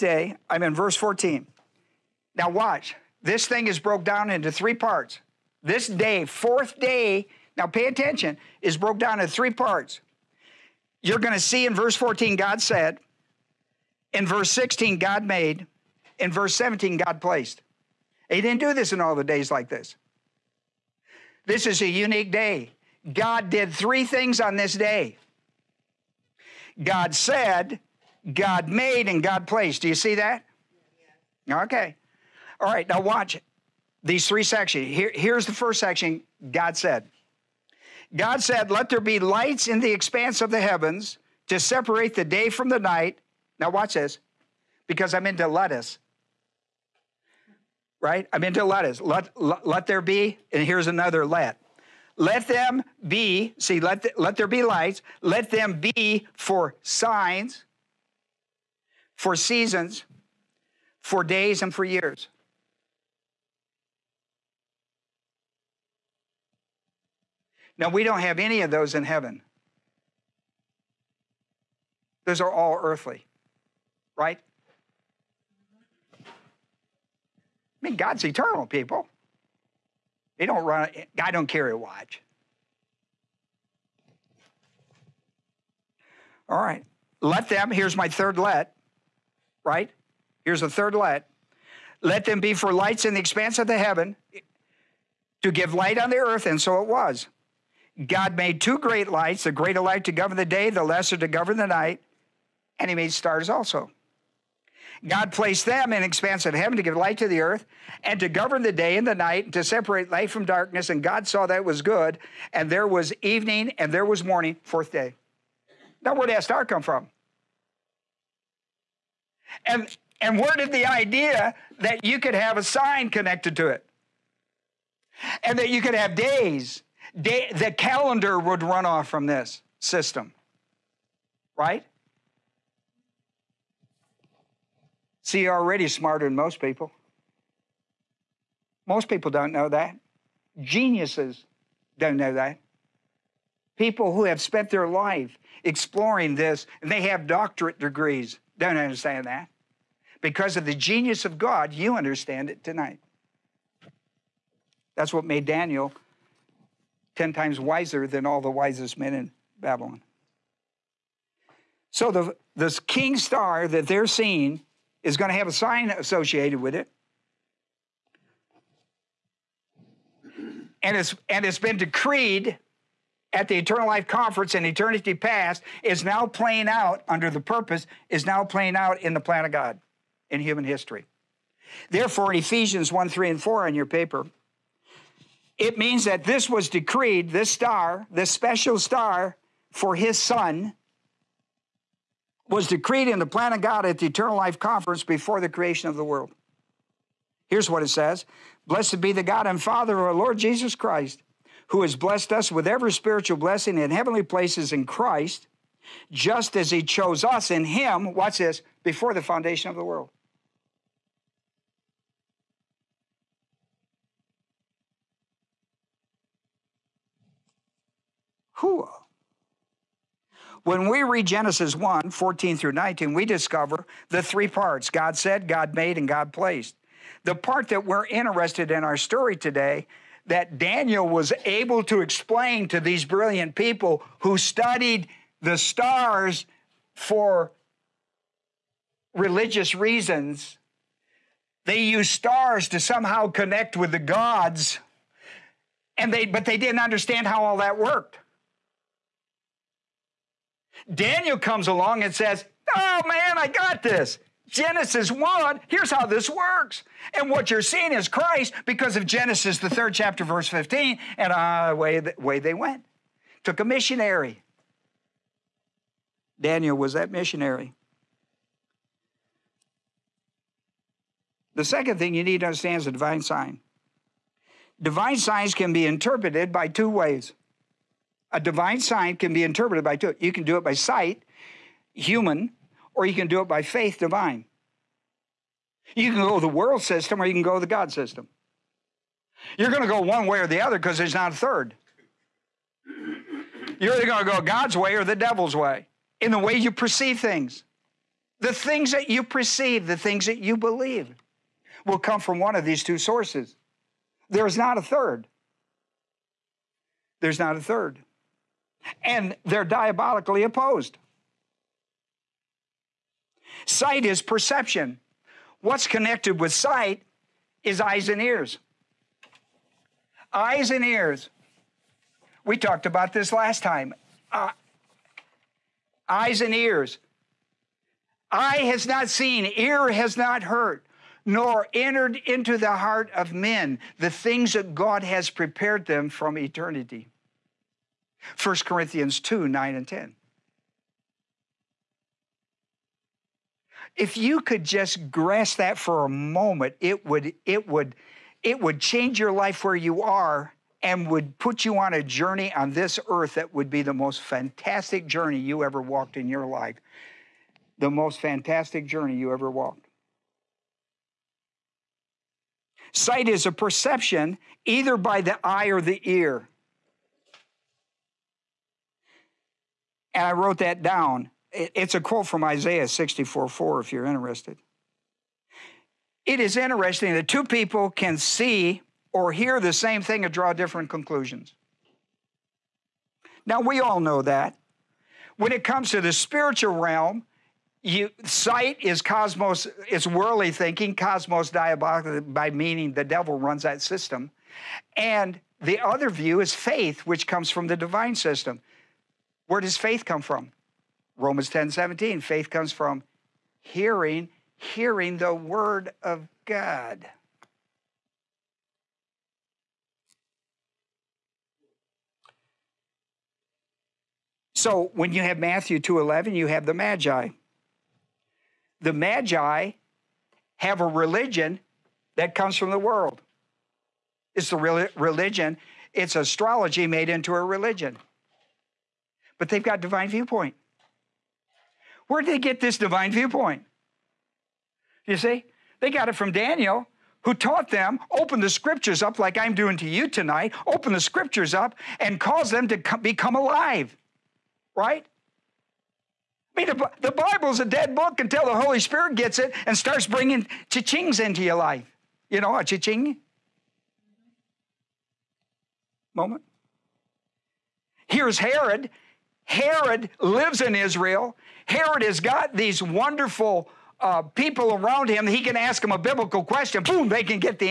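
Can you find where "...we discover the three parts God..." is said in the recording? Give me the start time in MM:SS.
03:43.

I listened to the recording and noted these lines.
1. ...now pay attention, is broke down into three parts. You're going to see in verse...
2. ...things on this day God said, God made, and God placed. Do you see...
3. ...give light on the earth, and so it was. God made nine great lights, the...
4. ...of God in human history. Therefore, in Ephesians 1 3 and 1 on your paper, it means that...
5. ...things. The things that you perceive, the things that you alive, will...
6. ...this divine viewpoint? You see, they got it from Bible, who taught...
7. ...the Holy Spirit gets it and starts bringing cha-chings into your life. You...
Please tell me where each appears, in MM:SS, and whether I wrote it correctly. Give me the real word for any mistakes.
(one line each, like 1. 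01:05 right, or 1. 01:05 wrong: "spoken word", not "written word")
1. 00:07 right
2. 00:24 right
3. 01:35 wrong: "two", not "nine"
4. 02:59 wrong: "4", not "1"
5. 04:57 wrong: "believe", not "alive"
6. 07:12 wrong: "Daniel", not "Bible"
7. 07:28 right.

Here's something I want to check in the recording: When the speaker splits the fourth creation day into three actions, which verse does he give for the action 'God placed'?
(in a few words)
Verse 17.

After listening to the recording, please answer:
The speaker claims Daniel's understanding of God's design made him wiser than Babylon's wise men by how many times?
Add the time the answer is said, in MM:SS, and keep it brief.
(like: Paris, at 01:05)
10, at 02:37.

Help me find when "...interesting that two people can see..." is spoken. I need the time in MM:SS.
06:16.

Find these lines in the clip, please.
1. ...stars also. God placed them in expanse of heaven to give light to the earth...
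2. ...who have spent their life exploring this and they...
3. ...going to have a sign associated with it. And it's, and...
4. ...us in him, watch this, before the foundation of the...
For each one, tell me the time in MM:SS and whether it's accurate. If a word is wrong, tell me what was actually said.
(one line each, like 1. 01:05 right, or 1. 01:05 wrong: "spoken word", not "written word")
1. 01:43 right
2. 02:24 right
3. 02:45 right
4. 03:27 right.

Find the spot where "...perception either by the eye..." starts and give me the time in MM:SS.
06:03.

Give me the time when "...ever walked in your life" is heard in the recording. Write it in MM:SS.
05:55.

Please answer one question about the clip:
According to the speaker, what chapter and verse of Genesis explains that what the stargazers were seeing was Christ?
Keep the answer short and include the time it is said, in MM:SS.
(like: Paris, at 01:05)
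Genesis 3:15, at 04:19.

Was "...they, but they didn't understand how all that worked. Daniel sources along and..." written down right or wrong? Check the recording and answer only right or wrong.
wrong.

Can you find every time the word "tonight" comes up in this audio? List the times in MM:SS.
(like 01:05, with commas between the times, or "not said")
02:32, 07:20.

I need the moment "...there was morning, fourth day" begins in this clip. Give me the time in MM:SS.
01:53.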